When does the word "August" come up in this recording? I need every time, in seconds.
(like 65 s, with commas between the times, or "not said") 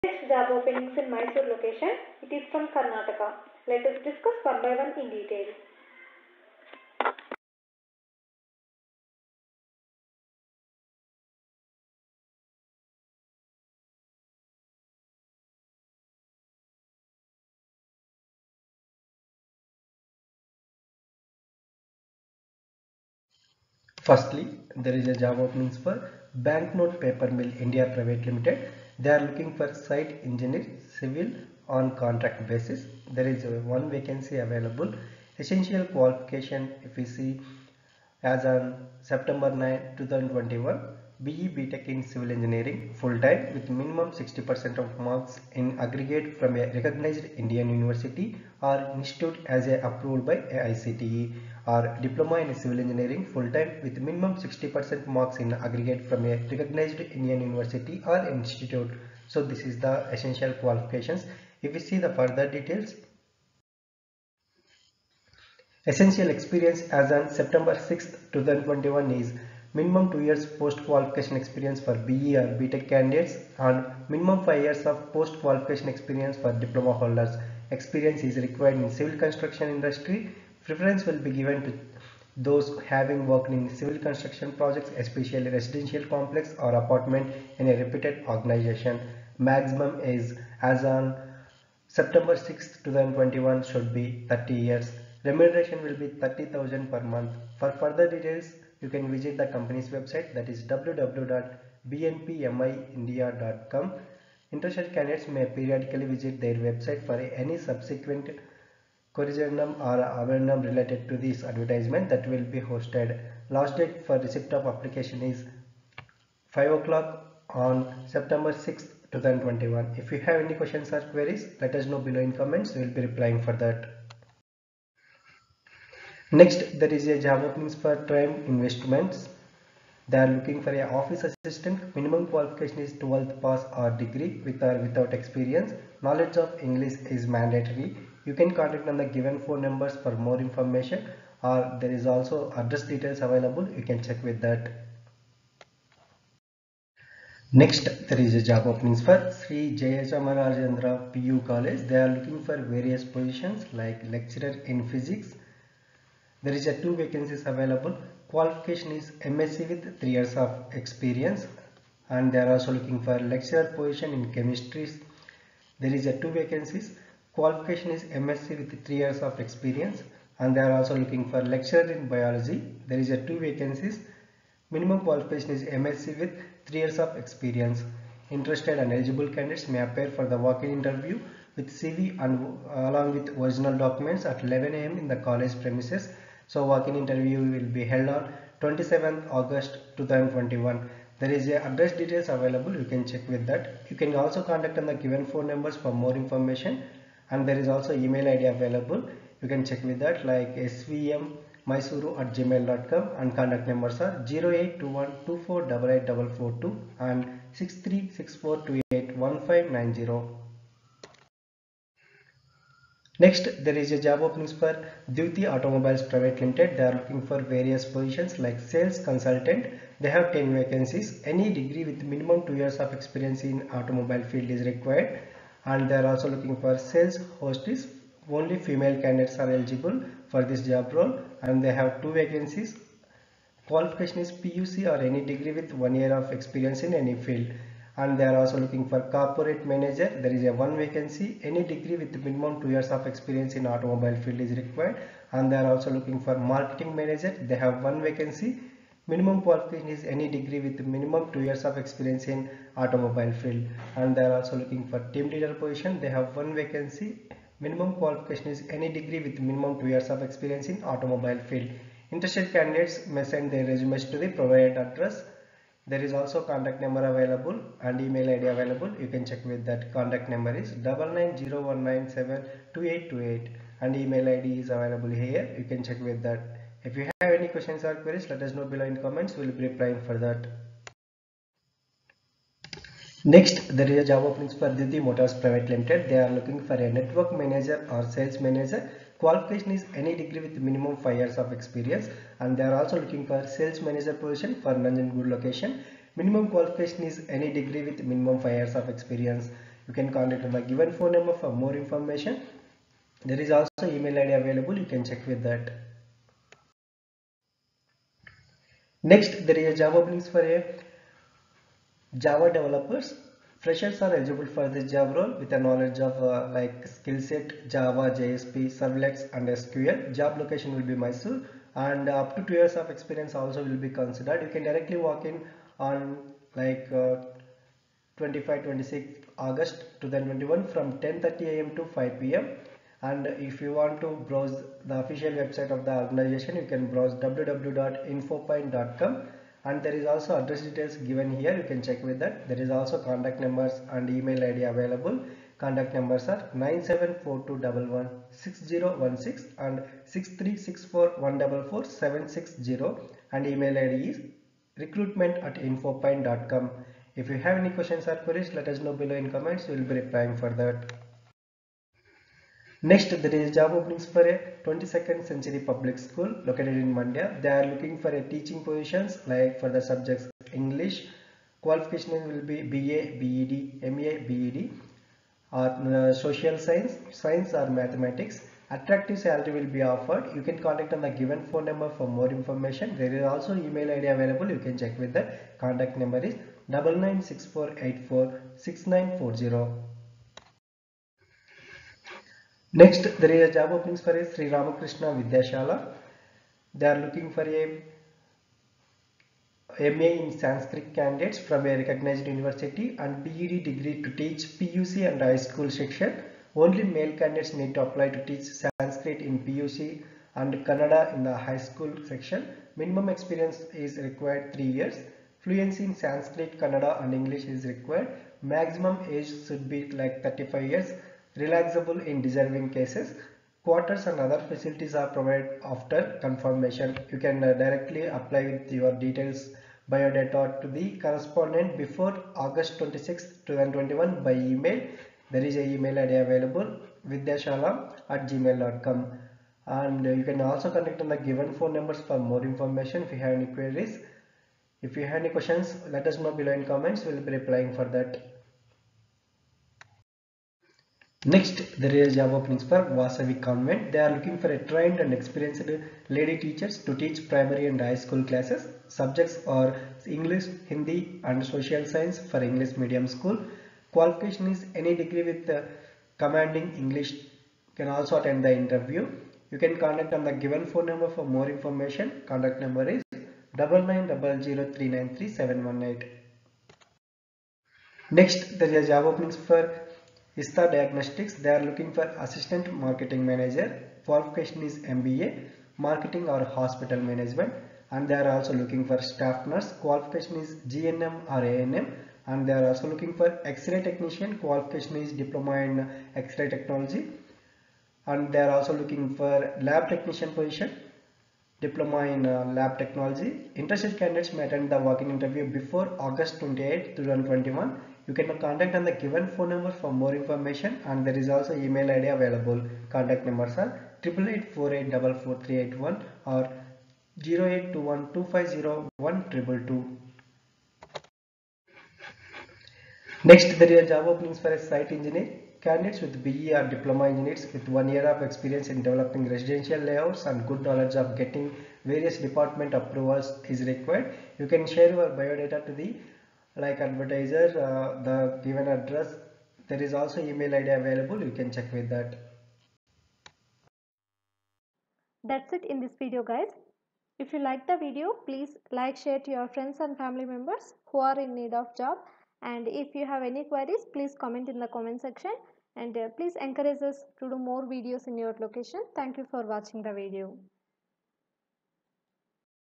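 189 s, 329 s, 432 s, 505 s.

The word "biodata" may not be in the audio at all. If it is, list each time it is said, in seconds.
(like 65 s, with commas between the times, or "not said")
429 s, 535 s.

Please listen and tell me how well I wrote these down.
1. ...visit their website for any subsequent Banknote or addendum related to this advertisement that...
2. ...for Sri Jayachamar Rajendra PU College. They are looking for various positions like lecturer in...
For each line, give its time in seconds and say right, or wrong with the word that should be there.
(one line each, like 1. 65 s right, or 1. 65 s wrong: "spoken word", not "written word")
1. 106 s wrong: "Corrigendum", not "Banknote"
2. 149 s right.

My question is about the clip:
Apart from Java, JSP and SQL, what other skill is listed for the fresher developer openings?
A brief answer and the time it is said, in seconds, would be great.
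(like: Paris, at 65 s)
Servlets, at 318 s.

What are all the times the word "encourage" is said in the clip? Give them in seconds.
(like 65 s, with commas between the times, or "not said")
556 s.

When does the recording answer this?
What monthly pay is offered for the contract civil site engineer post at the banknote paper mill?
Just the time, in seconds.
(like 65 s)
96 s.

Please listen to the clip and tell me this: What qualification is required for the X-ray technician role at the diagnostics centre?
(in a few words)
Diploma in X-ray technology.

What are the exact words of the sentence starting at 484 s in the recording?
Qualification is MBA, marketing or hospital management.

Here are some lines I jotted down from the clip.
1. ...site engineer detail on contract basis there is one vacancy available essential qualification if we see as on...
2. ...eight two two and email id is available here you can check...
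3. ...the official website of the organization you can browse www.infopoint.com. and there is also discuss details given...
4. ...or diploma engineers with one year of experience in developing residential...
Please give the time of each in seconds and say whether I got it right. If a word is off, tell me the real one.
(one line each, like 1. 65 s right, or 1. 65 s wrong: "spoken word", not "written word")
1. 29 s wrong: "civil", not "detail"
2. 272 s wrong: "eight", not "two"
3. 334 s wrong: "address", not "discuss"
4. 526 s right.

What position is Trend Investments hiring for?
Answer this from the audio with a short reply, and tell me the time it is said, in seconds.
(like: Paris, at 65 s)
Office assistant, at 130 s.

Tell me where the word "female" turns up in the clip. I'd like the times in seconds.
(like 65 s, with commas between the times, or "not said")
228 s.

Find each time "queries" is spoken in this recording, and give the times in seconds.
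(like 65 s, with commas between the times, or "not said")
121 s, 277 s, 358 s, 443 s, 553 s.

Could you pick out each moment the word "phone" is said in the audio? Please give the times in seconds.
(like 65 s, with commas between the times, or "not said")
139 s, 195 s, 300 s, 381 s, 441 s, 470 s, 509 s.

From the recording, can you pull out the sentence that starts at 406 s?
Only male candidates need to apply to teach Sanskrit in PUC and Kannada in the high school section.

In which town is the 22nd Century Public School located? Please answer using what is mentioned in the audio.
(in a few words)
Mandya.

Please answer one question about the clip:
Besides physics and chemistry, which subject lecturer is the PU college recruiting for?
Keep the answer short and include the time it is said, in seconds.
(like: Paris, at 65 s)
Biology, at 172 s.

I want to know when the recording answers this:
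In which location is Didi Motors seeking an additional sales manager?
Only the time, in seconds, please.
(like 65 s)
294 s.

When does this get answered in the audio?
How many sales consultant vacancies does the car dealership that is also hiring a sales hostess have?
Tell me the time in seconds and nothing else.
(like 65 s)
219 s.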